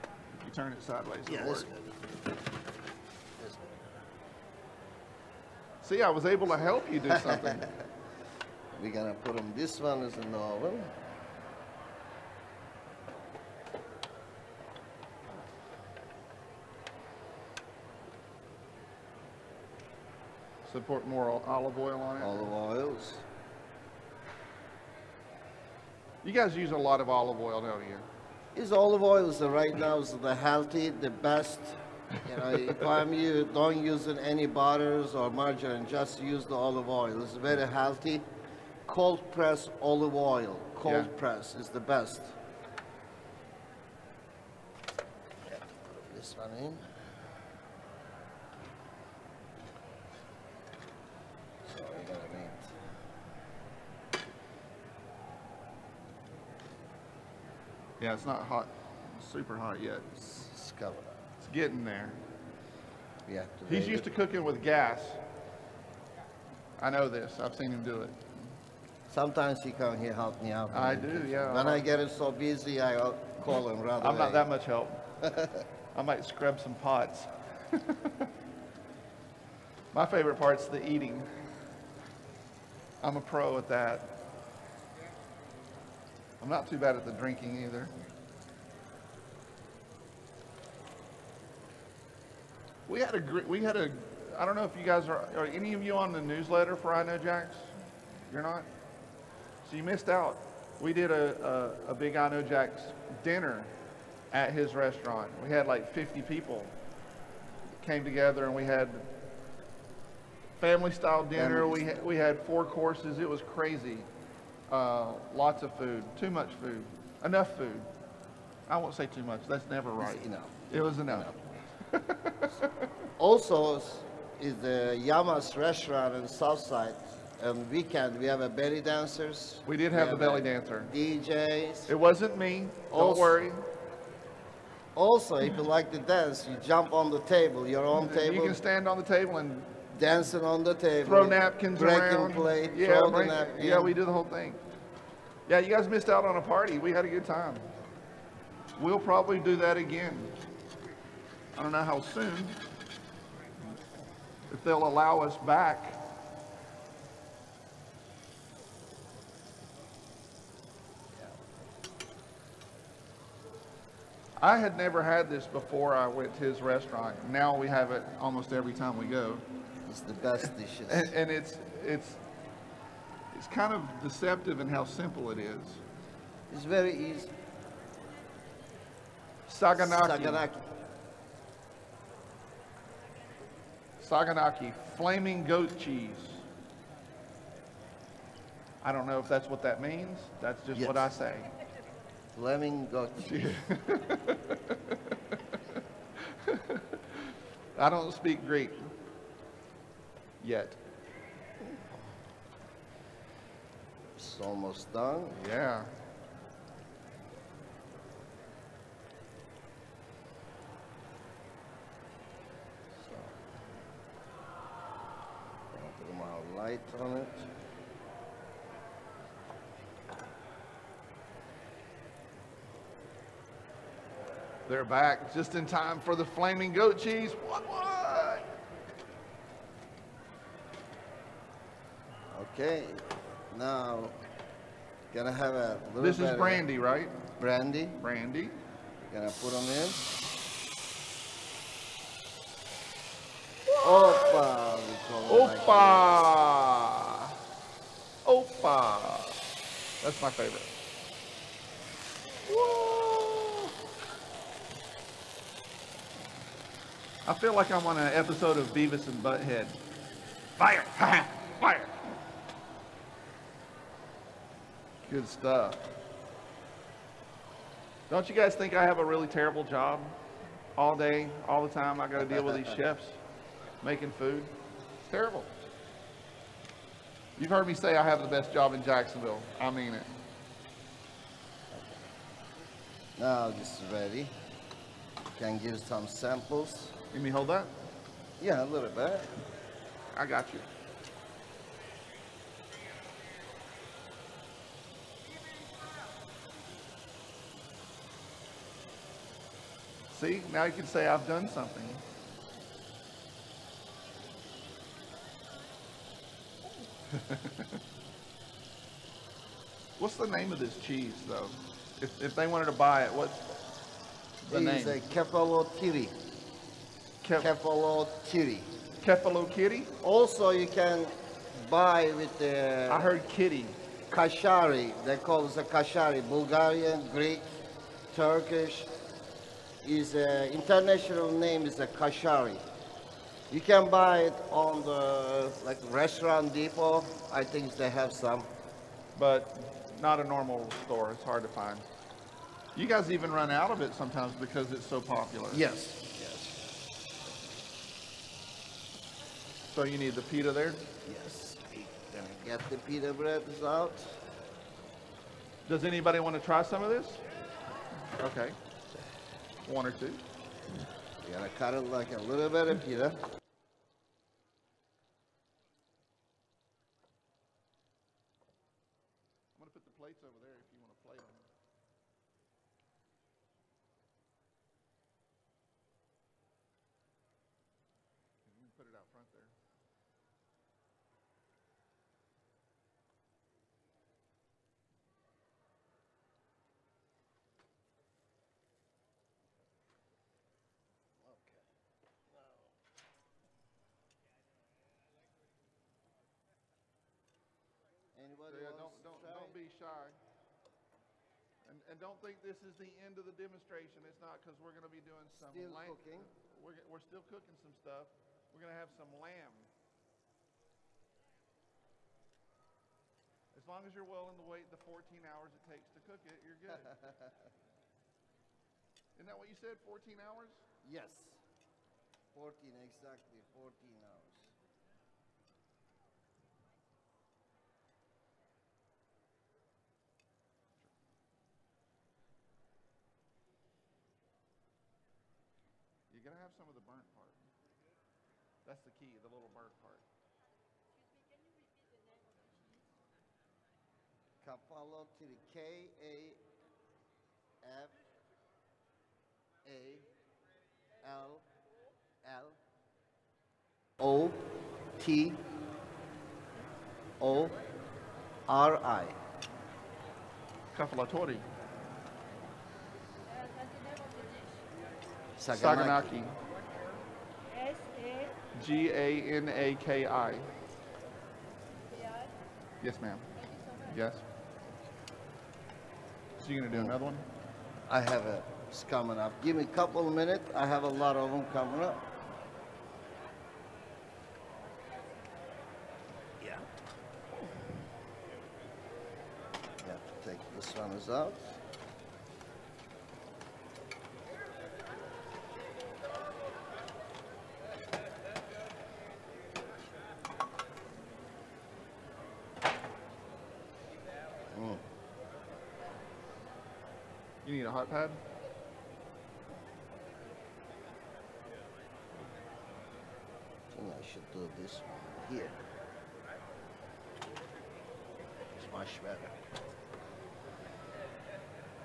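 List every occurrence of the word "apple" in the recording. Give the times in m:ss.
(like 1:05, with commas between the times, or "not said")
not said.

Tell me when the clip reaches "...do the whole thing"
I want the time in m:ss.
2:23.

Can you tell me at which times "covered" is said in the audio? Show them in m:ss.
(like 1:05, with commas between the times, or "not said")
1:00.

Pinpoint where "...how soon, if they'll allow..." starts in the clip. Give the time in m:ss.
2:31.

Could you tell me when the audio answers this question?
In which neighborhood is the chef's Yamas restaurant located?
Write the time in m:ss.
2:06.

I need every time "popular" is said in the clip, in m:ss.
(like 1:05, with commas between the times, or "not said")
5:44.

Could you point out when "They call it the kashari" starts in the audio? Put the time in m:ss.
5:25.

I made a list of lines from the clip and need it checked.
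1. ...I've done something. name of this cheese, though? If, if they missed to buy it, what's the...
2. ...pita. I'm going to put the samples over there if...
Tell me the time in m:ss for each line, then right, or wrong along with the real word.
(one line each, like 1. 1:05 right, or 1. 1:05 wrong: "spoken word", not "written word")
1. 5:01 wrong: "wanted", not "missed"
2. 6:02 wrong: "plates", not "samples".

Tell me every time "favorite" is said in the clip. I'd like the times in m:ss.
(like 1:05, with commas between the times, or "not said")
1:20, 4:10.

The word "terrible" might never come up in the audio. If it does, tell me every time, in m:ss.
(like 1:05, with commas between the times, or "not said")
4:29, 4:35.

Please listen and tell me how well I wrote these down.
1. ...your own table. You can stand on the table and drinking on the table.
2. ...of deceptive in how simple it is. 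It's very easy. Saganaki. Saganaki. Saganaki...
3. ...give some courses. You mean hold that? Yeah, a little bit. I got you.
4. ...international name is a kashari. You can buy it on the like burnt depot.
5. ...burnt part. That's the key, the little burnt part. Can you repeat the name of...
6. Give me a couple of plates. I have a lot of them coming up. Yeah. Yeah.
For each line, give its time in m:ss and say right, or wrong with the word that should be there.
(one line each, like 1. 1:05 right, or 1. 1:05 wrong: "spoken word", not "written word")
1. 2:17 wrong: "dancing", not "drinking"
2. 2:53 right
3. 4:45 wrong: "samples", not "courses"
4. 5:30 wrong: "restaurant", not "burnt"
5. 7:16 right
6. 7:59 wrong: "minutes", not "plates".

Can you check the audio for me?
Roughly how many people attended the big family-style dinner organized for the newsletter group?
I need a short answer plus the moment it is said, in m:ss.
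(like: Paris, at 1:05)
50, at 1:45.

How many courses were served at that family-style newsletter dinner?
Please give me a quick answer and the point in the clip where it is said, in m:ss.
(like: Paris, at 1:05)
4, at 1:52.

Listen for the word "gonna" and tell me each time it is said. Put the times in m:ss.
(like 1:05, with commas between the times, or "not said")
3:55, 3:59, 5:52, 7:56.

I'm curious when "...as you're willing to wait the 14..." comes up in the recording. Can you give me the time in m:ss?
6:53.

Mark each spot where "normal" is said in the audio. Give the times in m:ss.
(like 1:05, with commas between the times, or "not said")
5:40.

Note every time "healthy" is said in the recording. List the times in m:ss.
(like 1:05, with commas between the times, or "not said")
0:30, 0:37.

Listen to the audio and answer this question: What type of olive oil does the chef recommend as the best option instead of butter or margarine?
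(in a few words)
Cold press.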